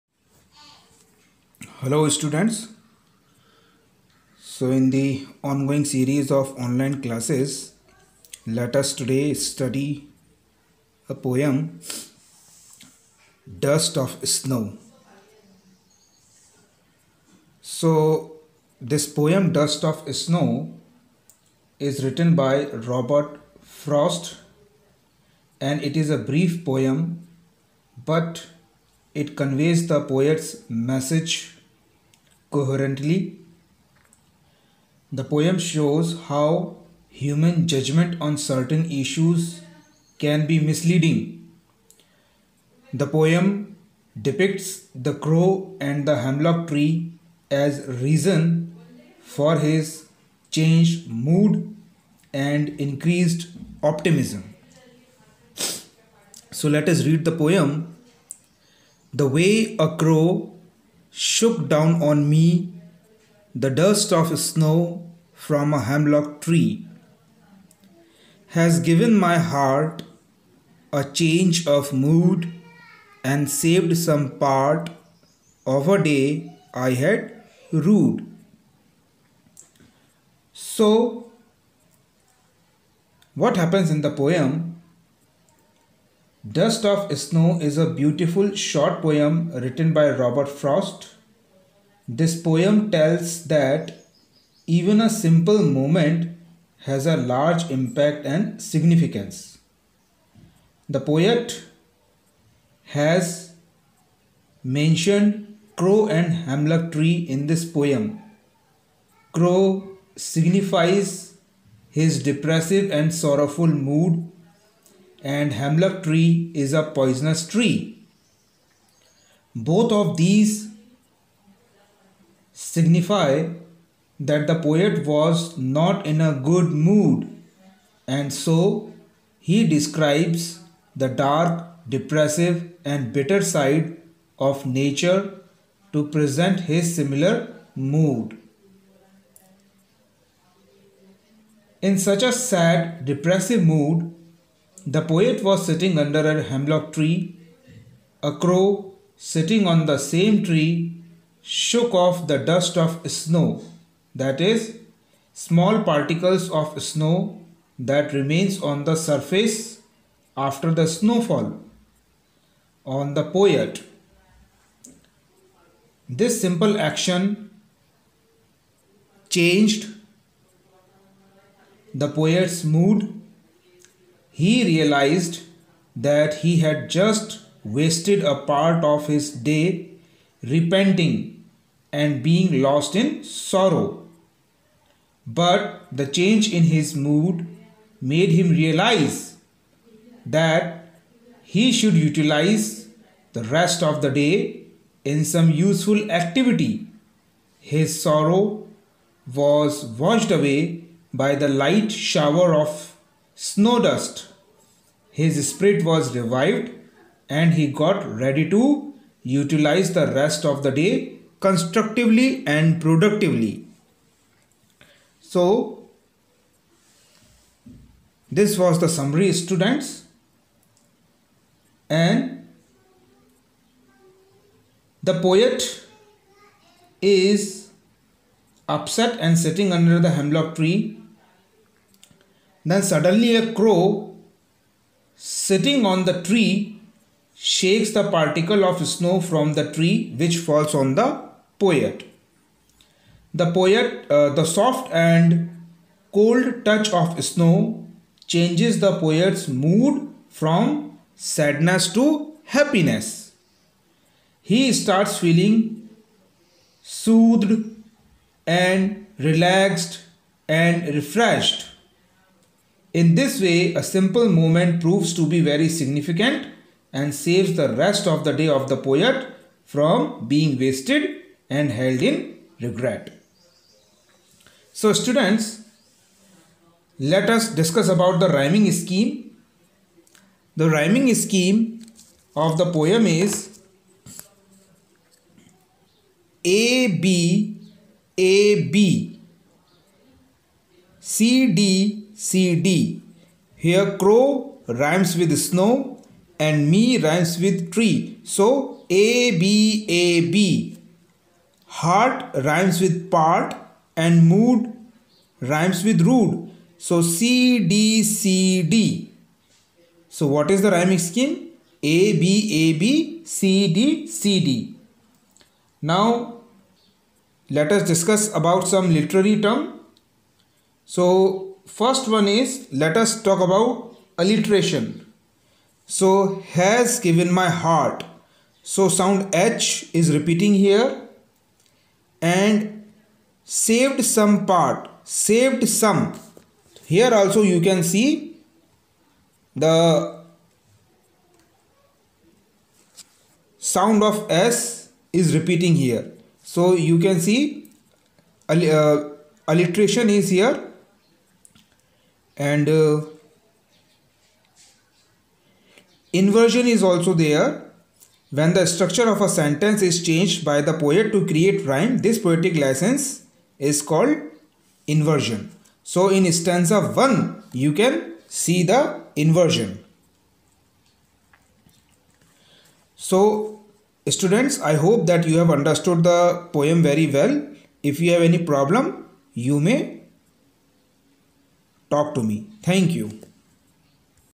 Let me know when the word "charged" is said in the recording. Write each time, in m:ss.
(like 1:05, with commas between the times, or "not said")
not said.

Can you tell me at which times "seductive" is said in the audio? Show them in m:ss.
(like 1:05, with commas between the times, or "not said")
not said.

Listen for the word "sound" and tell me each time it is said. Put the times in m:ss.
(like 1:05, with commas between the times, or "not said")
5:28, 5:43.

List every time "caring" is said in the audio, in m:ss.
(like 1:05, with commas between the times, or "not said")
not said.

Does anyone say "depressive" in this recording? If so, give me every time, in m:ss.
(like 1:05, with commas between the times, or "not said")
1:52, 2:11, 2:23.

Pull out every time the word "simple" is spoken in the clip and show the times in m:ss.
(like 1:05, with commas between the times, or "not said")
1:35, 2:46, 4:23.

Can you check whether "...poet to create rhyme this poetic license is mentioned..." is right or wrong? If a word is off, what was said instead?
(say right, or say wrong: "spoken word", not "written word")
wrong: "called", not "mentioned".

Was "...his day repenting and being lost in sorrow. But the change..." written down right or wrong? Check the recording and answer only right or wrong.
right.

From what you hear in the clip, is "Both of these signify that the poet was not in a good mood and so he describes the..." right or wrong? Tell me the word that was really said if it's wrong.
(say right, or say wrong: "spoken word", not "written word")
right.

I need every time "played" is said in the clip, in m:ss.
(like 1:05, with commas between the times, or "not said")
not said.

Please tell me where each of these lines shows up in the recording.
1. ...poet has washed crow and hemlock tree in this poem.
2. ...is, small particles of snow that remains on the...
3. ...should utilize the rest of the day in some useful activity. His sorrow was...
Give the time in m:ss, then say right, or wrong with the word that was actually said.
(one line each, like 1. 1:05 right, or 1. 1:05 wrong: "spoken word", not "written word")
1. 1:40 wrong: "mentioned", not "washed"
2. 2:34 right
3. 3:11 right.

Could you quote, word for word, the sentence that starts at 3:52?
Then, suddenly, a crow sitting on the tree shakes the particle of snow from the tree which falls on the poet.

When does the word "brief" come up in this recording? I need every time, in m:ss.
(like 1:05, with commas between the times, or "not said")
0:26.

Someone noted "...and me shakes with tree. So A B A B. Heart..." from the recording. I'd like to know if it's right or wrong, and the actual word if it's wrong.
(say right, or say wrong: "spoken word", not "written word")
wrong: "rhymes", not "shakes".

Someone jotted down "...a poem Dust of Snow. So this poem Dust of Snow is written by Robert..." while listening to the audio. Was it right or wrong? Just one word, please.
right.